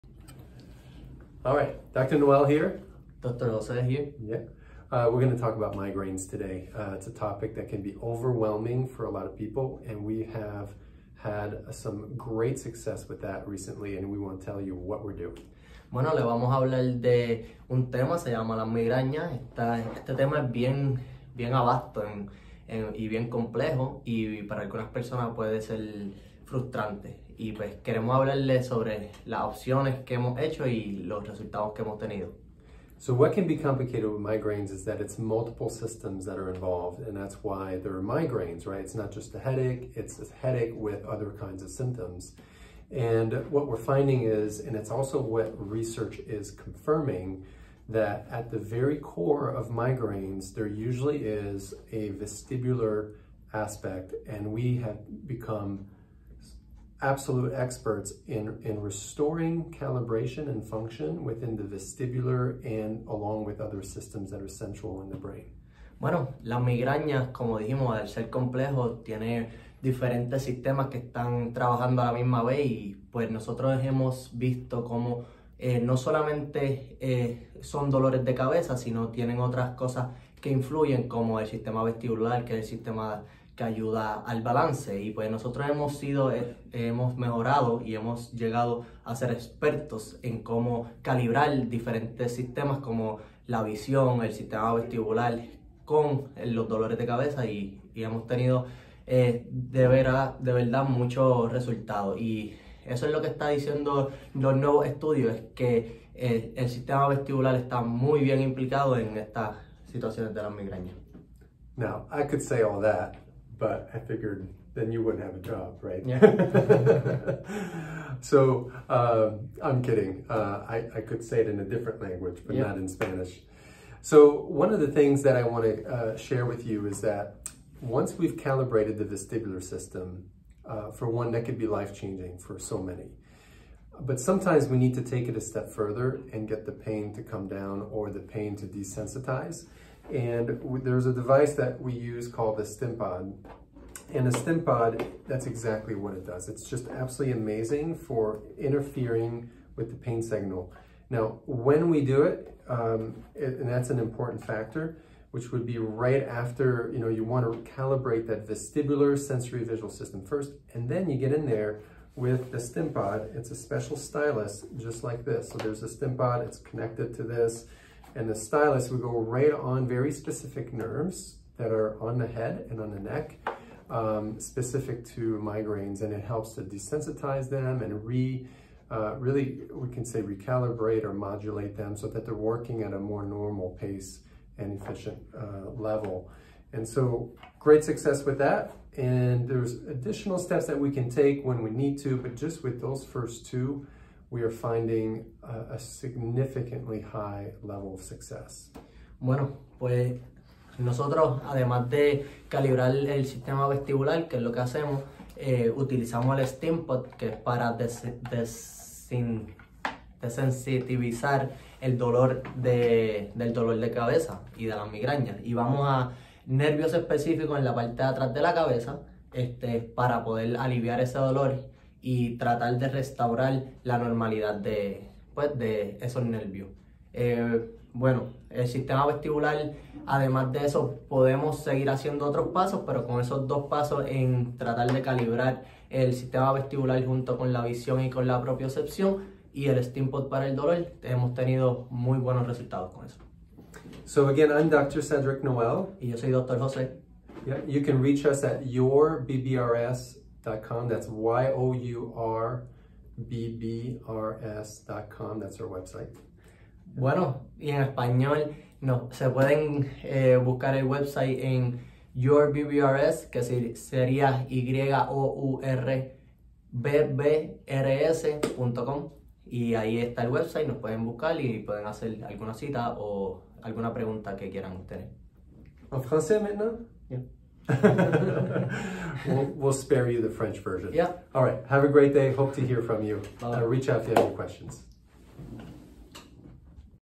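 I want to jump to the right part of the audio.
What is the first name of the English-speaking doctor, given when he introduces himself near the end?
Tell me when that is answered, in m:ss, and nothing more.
4:05.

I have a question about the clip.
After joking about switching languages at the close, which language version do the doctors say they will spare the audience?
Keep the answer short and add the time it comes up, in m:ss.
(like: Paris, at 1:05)
French, at 4:40.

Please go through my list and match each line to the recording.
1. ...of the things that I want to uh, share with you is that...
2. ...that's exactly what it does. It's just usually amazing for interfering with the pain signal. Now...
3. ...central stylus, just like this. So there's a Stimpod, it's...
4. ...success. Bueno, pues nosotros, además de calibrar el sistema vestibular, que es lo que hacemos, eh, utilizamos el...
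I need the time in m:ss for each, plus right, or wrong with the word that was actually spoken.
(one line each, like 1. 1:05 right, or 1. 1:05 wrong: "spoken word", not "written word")
1. 2:04 right
2. 2:25 wrong: "absolutely", not "usually"
3. 2:43 wrong: "special", not "central"
4. 3:18 right.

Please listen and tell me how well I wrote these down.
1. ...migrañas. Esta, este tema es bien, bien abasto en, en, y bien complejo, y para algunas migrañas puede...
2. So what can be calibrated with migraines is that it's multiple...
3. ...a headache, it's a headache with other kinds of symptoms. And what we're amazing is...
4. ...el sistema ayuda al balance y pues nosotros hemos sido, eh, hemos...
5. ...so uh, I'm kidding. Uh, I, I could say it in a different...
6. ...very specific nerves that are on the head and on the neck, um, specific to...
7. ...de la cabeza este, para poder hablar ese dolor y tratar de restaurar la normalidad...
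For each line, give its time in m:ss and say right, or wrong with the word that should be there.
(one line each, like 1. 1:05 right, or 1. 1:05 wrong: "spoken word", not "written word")
1. 0:18 wrong: "personas", not "migrañas"
2. 0:32 wrong: "complicated", not "calibrated"
3. 0:39 wrong: "finding", not "amazing"
4. 1:22 right
5. 1:58 right
6. 2:49 right
7. 3:38 wrong: "aliviar", not "hablar".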